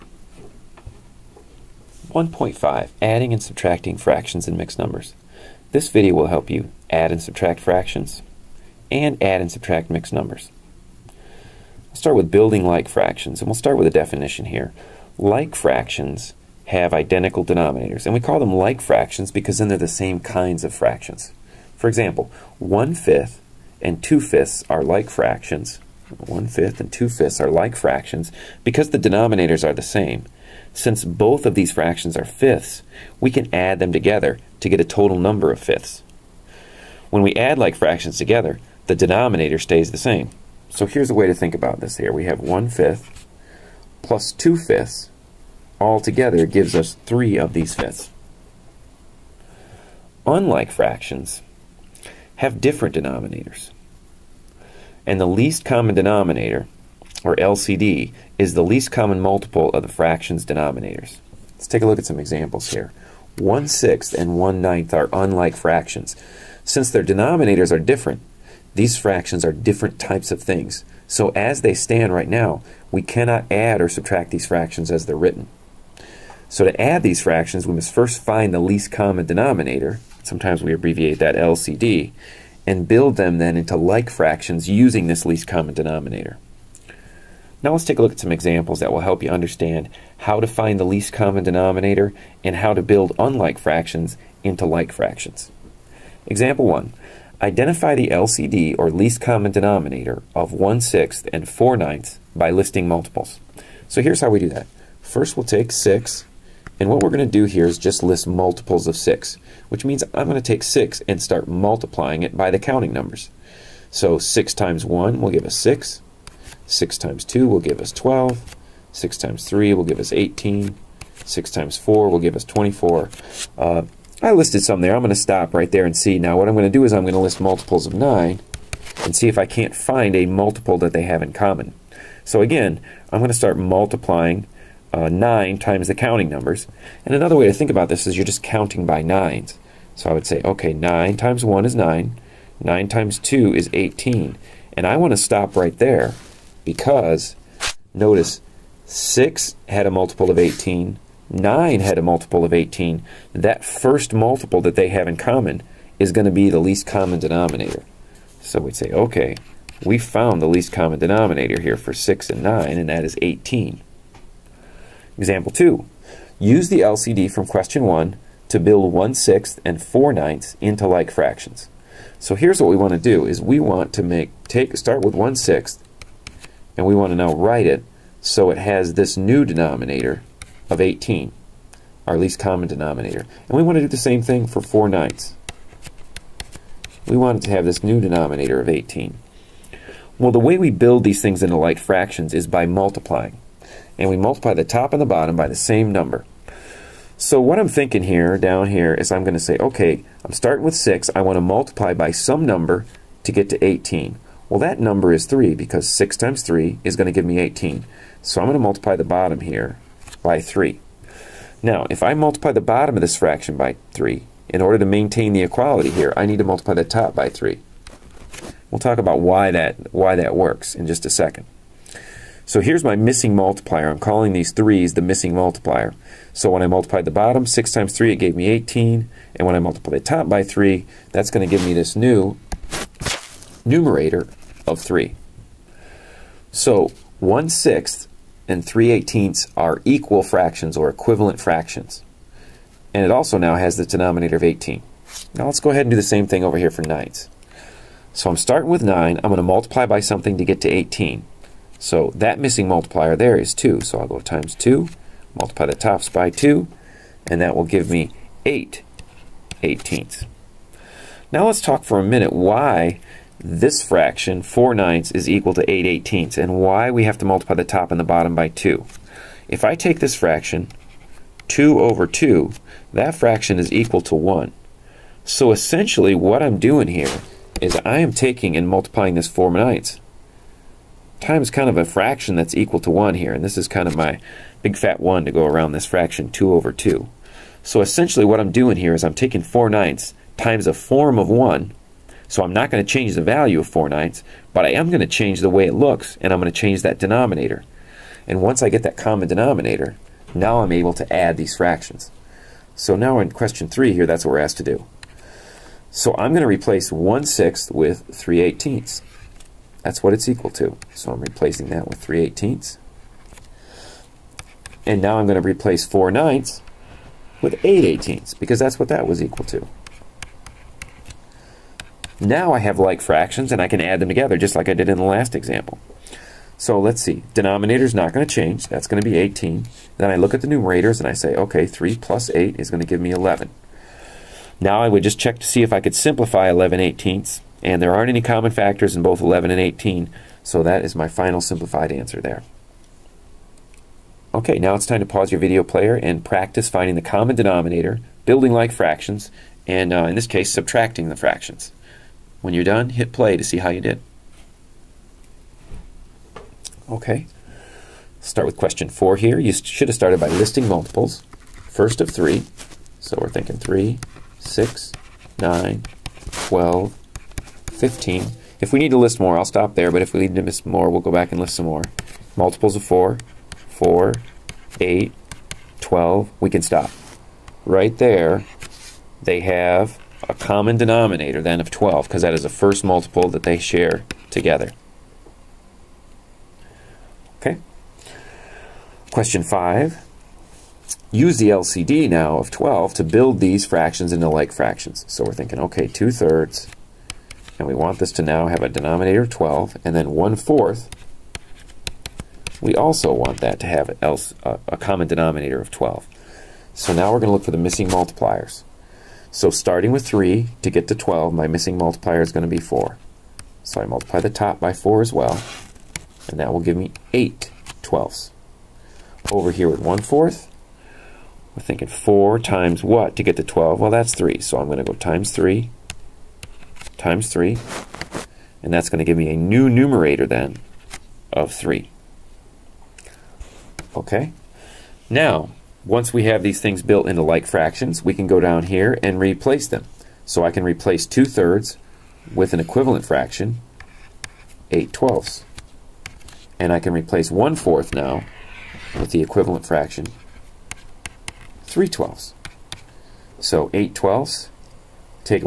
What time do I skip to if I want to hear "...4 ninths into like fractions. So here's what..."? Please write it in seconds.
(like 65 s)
169 s.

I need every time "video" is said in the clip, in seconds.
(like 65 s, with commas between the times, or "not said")
5 s, 345 s.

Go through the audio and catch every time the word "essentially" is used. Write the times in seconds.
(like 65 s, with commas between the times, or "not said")
275 s, 287 s.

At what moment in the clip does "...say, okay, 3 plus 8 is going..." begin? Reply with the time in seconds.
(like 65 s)
331 s.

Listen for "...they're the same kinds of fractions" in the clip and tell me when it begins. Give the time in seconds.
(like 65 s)
19 s.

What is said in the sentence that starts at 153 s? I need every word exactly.
That first multiple that they have in common is going to be the least common denominator.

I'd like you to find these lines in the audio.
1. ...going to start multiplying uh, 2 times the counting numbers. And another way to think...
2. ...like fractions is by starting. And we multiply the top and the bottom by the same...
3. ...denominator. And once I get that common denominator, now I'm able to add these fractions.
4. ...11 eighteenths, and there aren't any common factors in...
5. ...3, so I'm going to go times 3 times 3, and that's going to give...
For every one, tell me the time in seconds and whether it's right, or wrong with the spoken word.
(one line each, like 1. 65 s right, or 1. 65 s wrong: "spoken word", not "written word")
1. 133 s wrong: "9", not "2"
2. 191 s wrong: "multiplying", not "starting"
3. 296 s right
4. 336 s right
5. 424 s right.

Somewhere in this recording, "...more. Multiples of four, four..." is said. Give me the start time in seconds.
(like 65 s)
371 s.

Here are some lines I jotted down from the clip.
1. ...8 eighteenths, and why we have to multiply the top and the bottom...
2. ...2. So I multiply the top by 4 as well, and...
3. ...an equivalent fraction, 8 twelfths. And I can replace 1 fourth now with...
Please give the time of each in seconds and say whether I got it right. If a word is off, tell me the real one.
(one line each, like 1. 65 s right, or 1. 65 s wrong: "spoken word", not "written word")
1. 265 s right
2. 412 s wrong: "4", not "2"
3. 442 s right.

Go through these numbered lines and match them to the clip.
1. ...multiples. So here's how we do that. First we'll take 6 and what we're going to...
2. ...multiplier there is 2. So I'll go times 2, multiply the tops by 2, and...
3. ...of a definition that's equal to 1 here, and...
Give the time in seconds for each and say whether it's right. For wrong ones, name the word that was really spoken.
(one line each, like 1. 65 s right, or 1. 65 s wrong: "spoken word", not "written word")
1. 102 s right
2. 252 s right
3. 281 s wrong: "fraction", not "definition".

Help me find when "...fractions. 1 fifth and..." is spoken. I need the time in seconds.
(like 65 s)
25 s.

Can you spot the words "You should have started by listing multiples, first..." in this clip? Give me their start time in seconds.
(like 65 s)
359 s.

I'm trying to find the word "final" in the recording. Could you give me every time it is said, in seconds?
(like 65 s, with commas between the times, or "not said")
341 s.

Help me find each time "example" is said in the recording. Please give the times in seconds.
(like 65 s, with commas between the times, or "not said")
21 s, 62 s, 88 s, 96 s, 165 s, 325 s.